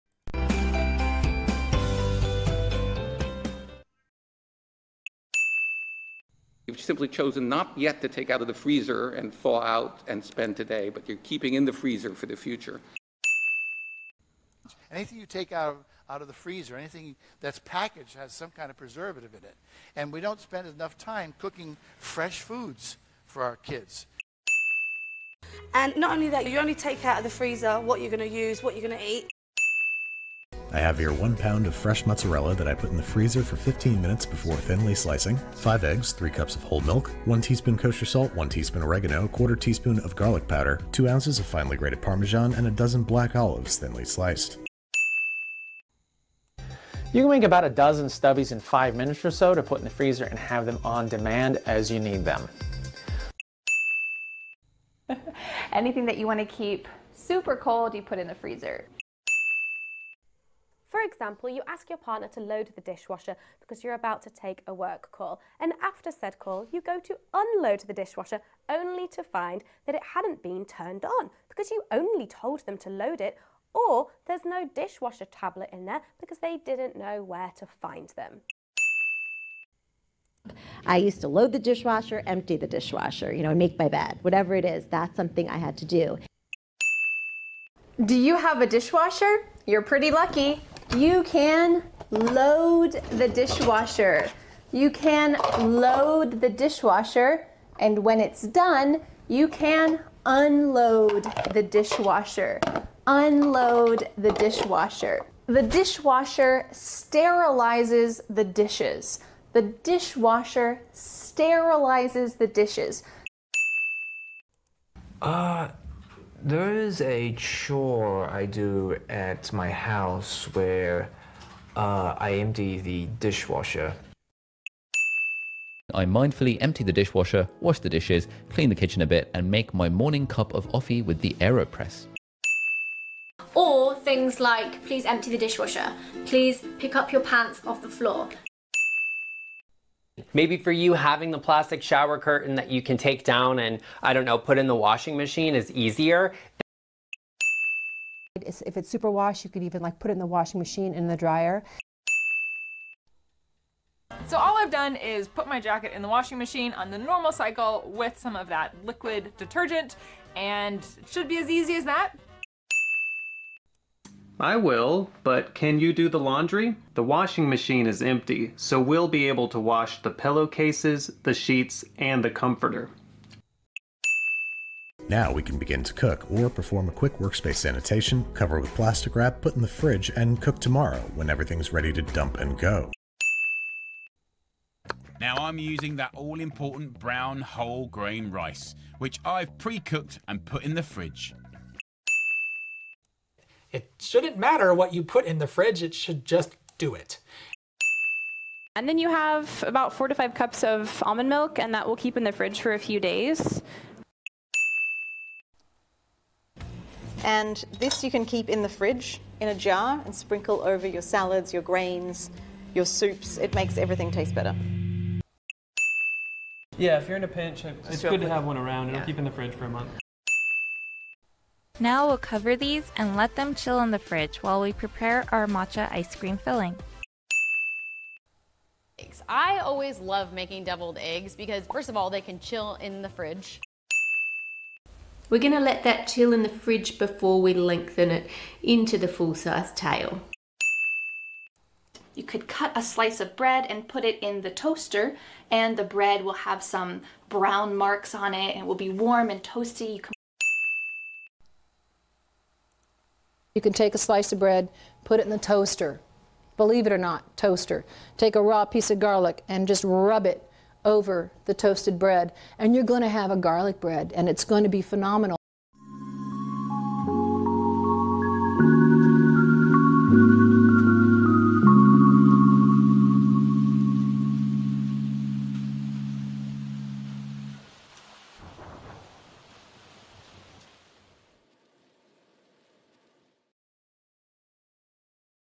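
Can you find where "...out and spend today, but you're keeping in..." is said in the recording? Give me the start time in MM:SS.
00:09.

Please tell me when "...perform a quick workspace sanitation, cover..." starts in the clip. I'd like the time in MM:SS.
02:56.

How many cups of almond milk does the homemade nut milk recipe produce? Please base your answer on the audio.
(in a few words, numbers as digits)
4 to 5 cups.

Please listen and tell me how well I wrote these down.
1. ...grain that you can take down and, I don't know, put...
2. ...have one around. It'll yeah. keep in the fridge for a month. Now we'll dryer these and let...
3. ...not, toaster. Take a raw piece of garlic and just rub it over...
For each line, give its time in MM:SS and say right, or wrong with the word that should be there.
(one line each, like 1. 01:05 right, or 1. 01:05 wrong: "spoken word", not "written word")
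1. 02:22 wrong: "curtain", not "grain"
2. 03:38 wrong: "cover", not "dryer"
3. 04:16 right.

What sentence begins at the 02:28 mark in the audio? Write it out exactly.
If it's super wash, you could even like put it in the washing machine in the dryer.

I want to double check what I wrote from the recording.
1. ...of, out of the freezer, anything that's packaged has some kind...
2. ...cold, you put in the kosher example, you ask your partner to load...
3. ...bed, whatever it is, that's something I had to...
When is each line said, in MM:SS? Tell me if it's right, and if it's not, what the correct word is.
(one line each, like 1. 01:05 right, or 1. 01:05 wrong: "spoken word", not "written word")
1. 00:15 right
2. 00:57 wrong: "freezer", not "kosher"
3. 01:23 right.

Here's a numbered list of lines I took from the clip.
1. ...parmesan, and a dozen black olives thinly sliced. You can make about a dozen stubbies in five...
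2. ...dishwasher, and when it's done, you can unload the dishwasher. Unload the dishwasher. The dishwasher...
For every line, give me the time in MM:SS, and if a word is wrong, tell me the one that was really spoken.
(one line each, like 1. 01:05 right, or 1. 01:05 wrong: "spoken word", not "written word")
1. 00:42 right
2. 01:36 right.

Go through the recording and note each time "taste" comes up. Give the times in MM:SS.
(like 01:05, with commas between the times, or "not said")
03:34.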